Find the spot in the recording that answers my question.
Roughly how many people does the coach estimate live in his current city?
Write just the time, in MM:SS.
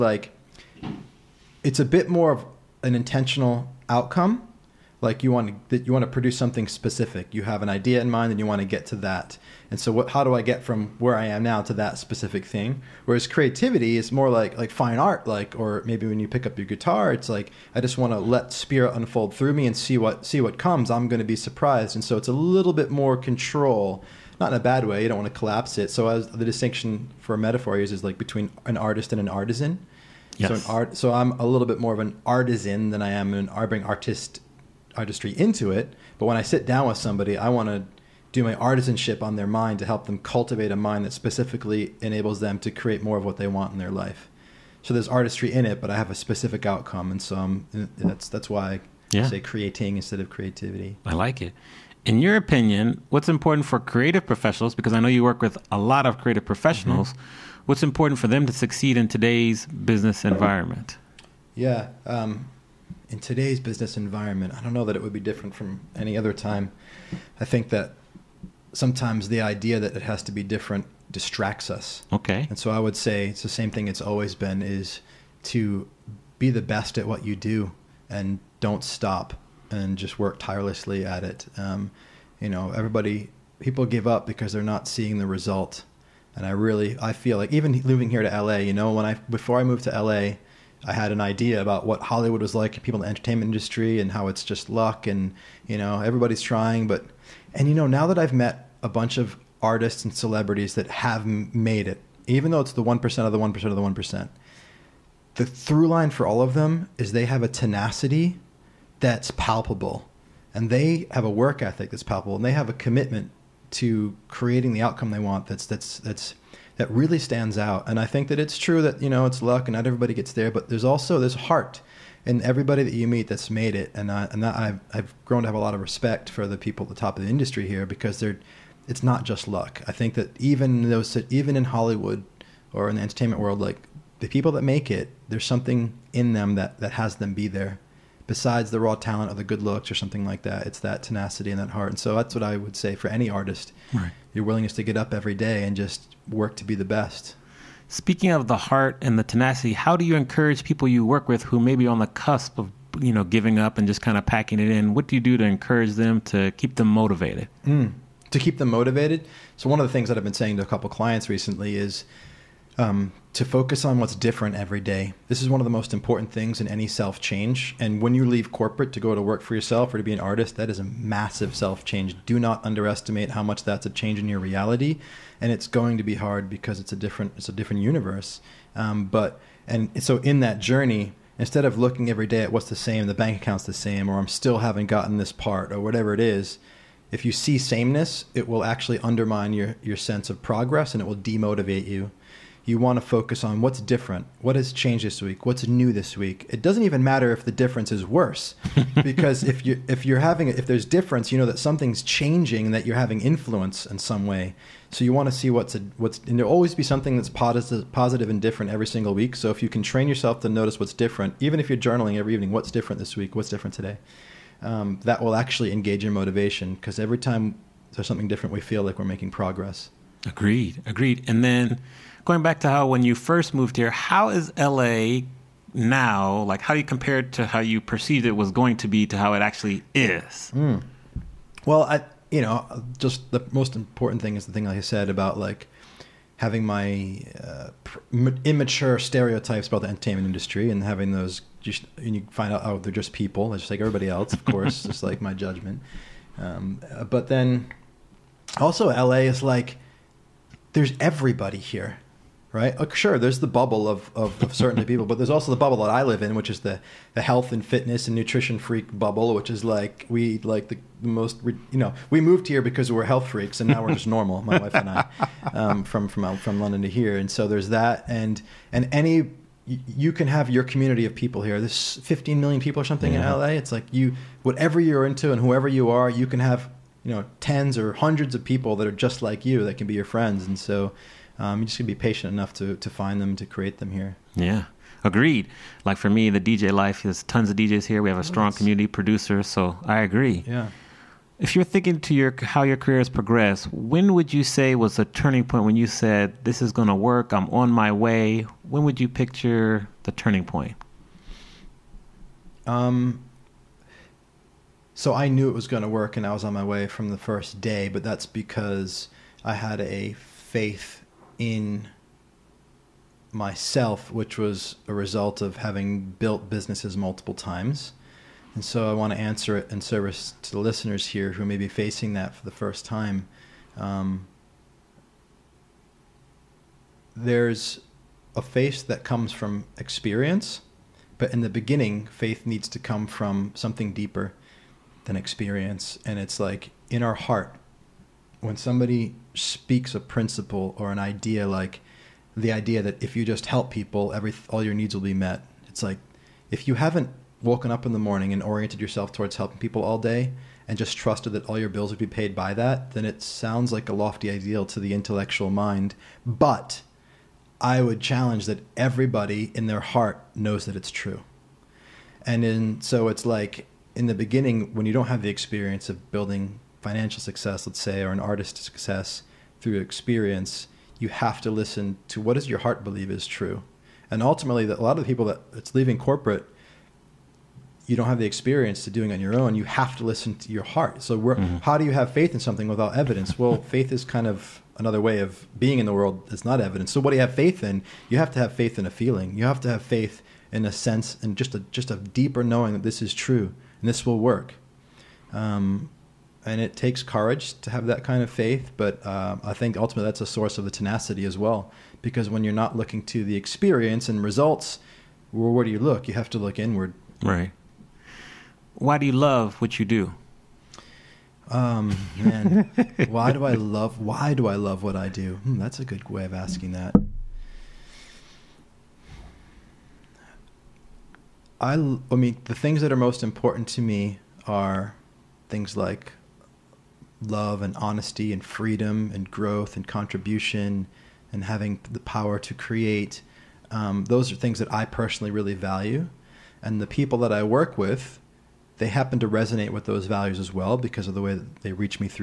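04:32.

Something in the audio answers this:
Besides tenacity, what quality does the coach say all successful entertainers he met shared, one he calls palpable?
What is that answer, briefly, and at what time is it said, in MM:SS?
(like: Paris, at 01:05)
Work ethic, at 01:51.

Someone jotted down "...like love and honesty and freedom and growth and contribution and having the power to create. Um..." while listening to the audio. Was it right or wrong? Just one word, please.
right.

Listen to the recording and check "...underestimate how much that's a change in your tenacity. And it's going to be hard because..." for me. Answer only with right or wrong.
wrong.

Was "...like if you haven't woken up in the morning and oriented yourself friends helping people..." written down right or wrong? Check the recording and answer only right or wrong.
wrong.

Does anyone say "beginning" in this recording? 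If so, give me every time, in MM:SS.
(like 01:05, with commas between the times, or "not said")
05:31, 06:04.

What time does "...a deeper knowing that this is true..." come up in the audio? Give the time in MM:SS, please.
06:31.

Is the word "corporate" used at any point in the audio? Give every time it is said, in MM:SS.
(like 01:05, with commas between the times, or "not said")
02:48, 06:15.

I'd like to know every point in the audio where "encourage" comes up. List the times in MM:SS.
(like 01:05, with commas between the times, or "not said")
02:30, 02:35.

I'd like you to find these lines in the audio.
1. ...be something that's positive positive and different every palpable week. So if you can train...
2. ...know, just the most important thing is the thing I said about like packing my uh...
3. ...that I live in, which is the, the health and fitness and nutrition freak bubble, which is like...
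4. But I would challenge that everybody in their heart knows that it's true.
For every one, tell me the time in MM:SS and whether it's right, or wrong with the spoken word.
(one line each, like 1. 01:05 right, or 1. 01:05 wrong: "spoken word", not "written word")
1. 03:26 wrong: "single", not "palpable"
2. 03:52 wrong: "having", not "packing"
3. 04:15 right
4. 05:56 right.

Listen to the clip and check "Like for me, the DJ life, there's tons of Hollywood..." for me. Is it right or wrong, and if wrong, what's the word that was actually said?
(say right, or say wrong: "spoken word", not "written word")
wrong: "DJs", not "Hollywood".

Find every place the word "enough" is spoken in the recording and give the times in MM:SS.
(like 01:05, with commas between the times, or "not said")
04:42.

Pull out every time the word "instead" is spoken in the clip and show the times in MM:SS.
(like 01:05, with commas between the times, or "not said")
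00:49, 03:01.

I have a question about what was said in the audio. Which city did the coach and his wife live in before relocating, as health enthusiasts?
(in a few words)
London.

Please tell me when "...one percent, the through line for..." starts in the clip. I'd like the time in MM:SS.
01:43.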